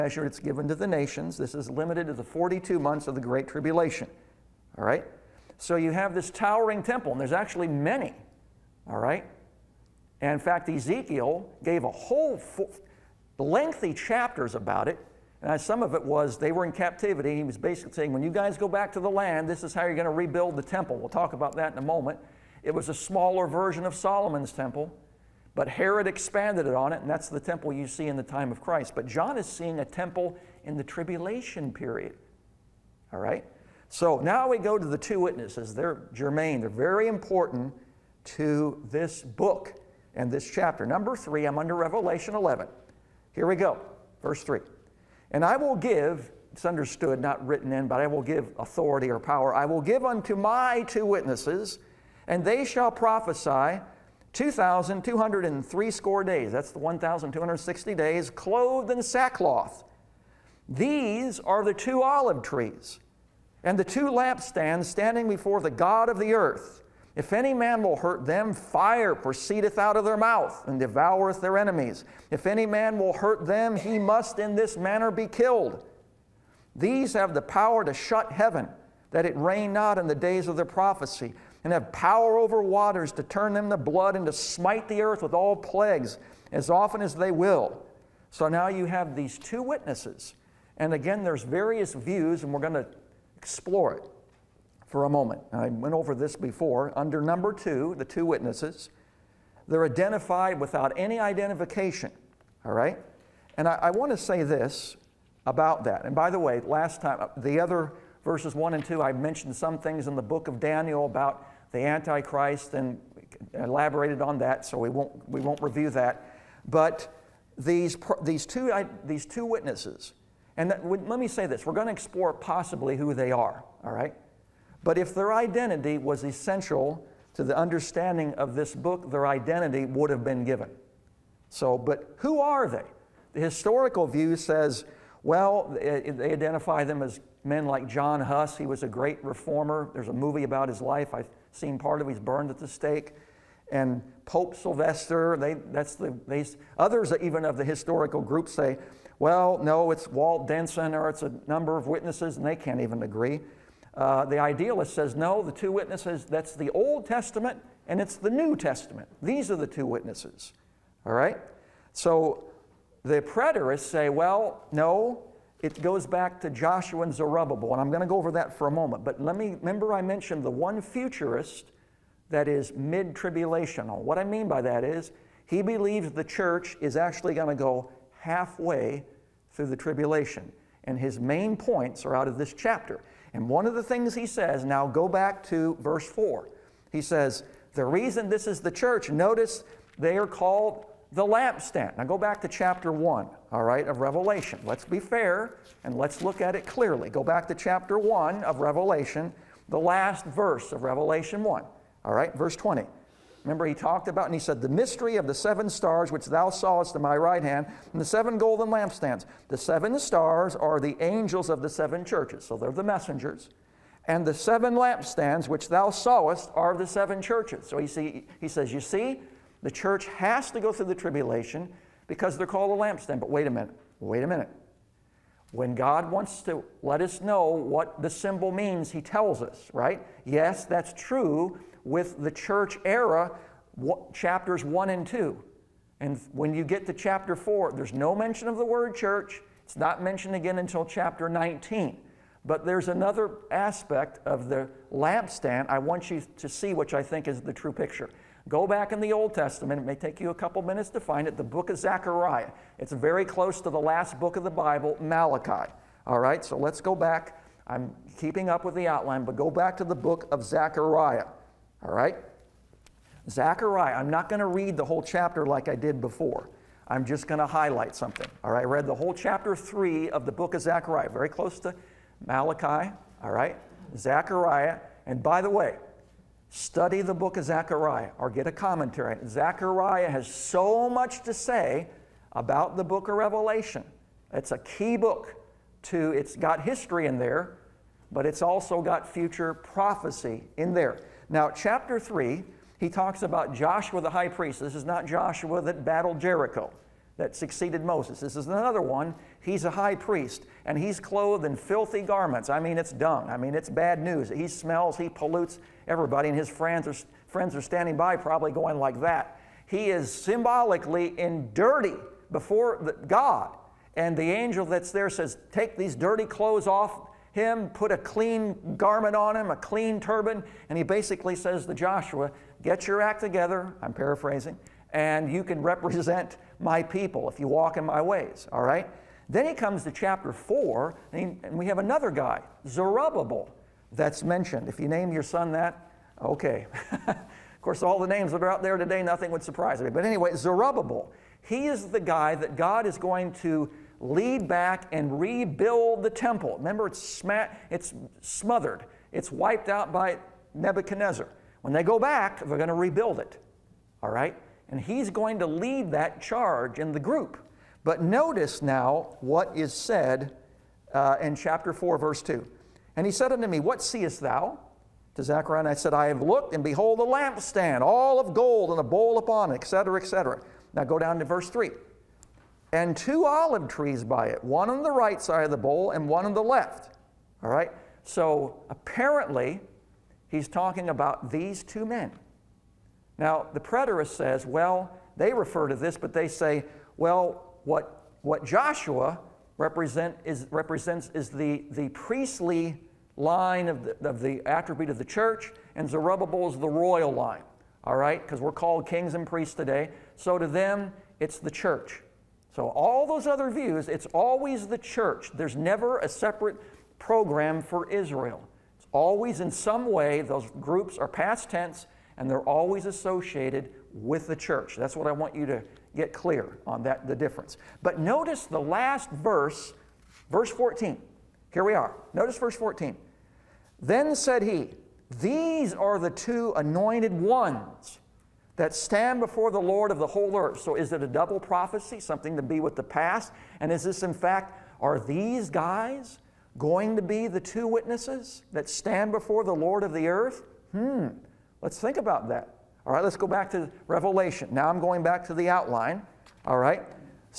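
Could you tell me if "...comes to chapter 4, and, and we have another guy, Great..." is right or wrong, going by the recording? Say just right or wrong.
wrong.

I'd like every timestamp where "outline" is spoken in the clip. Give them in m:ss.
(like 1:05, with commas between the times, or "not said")
4:18, 7:25.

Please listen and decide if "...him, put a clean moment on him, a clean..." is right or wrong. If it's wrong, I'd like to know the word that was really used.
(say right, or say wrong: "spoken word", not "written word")
wrong: "garment", not "moment".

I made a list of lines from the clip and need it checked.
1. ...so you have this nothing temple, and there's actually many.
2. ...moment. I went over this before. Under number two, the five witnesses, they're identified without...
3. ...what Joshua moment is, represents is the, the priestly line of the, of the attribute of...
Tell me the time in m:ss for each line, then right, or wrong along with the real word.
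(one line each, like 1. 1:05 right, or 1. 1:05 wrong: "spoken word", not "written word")
1. 0:05 wrong: "towering", not "nothing"
2. 1:35 wrong: "two", not "five"
3. 6:28 wrong: "represent", not "moment".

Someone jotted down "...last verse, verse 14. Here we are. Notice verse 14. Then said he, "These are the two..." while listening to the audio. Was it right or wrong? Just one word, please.
right.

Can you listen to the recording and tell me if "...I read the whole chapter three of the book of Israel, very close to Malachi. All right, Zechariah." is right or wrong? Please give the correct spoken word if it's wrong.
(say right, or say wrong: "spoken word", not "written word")
wrong: "Zechariah", not "Israel".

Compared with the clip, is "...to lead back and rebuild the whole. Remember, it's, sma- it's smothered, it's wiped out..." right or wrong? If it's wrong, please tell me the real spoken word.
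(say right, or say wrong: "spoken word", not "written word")
wrong: "temple", not "whole".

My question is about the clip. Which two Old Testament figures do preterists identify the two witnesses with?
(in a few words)
Joshua and Zerubbabel.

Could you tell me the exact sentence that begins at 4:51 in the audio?
Now, chapter 3, he talks about Joshua the high priest.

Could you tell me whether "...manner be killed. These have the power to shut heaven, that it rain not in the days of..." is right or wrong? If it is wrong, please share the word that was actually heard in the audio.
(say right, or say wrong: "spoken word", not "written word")
right.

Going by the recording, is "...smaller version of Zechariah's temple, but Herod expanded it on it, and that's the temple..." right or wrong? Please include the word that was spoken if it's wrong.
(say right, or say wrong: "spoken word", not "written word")
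wrong: "Solomon", not "Zechariah".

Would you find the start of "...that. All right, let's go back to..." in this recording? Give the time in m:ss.
7:22.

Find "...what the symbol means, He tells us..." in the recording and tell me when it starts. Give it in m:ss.
3:47.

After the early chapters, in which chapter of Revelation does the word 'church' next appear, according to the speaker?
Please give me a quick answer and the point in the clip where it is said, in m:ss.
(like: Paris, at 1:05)
19, at 4:01.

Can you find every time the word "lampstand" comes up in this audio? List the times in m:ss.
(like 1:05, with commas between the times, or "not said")
1:04, 3:11, 3:28, 3:34, 3:42, 4:04, 6:07.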